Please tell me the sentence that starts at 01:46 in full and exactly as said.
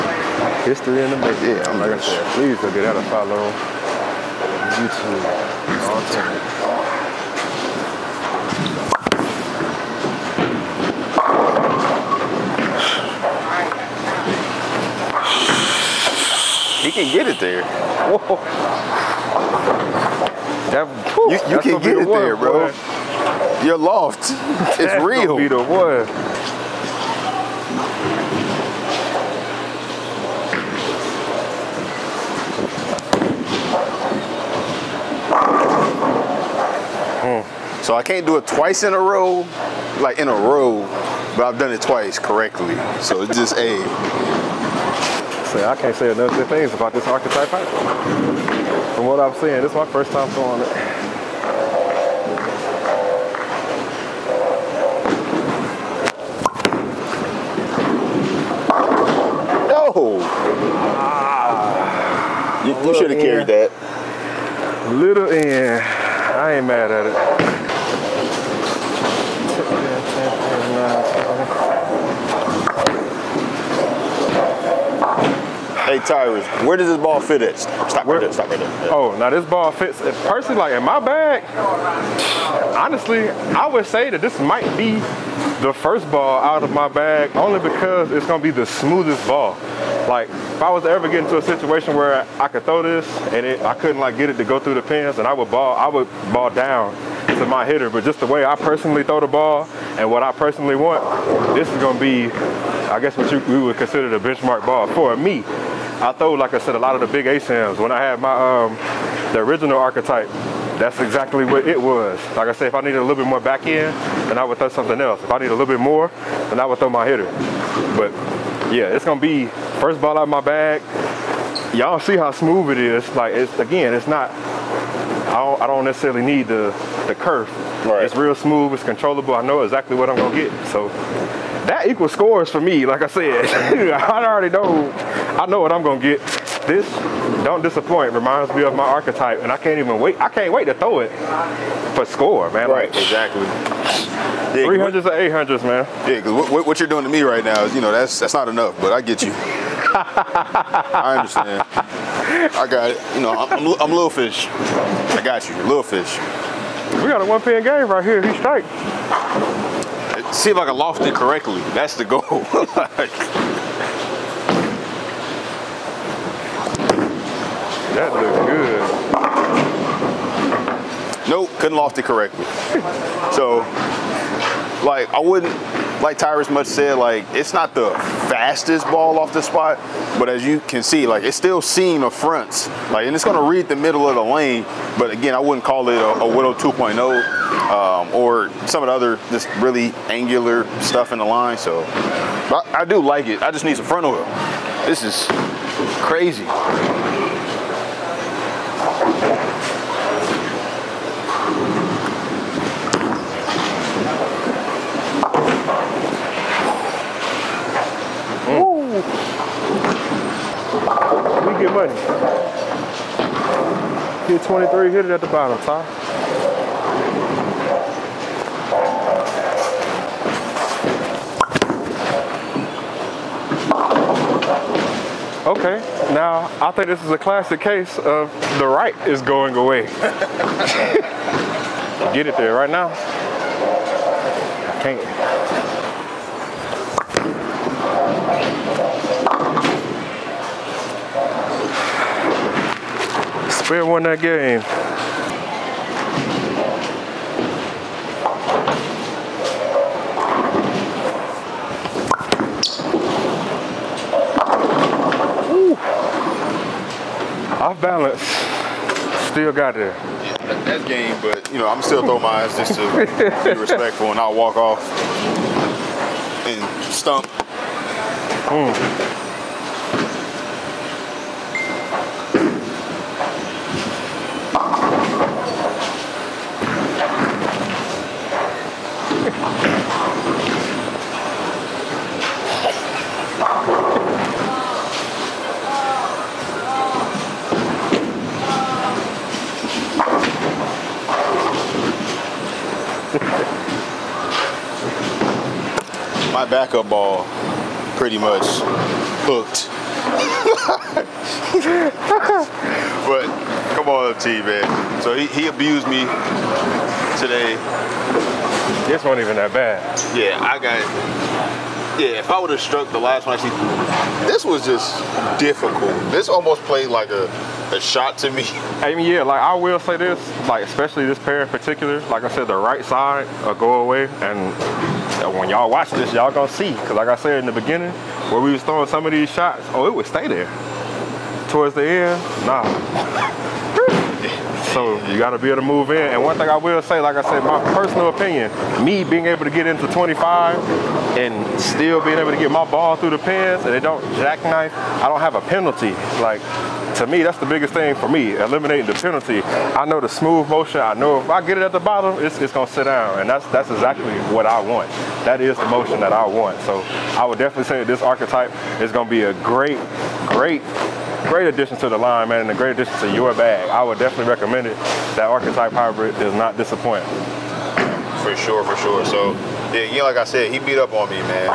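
I throw, like I said, a lot of the big ASINs.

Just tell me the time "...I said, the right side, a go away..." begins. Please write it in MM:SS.
05:22.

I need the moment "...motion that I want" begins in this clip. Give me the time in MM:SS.
05:55.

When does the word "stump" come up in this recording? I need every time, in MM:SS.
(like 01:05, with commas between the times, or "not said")
04:26.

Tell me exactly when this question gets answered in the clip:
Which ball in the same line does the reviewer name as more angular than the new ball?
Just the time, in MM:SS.
03:06.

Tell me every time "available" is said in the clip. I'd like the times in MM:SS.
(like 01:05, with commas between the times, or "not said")
not said.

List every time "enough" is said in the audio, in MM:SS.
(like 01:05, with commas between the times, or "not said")
00:46, 02:28.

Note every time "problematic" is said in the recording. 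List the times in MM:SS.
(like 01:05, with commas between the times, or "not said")
not said.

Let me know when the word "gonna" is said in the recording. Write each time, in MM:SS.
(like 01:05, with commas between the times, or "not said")
01:28, 01:41, 01:59, 02:10, 02:15, 05:26.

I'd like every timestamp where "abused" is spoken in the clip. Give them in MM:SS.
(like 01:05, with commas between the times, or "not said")
05:05.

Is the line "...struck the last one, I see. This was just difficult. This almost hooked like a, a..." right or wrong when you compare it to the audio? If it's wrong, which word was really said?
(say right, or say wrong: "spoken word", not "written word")
wrong: "played", not "hooked".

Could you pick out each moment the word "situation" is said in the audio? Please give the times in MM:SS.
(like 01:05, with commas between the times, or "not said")
01:31.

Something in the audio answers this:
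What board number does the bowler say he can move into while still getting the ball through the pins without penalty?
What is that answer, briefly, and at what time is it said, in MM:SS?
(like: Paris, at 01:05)
25, at 05:39.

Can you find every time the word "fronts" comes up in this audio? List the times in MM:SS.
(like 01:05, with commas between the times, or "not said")
03:02, 03:13.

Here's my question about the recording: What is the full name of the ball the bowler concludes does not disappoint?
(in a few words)
Archetype Hybrid.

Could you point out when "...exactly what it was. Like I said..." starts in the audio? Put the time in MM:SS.
01:51.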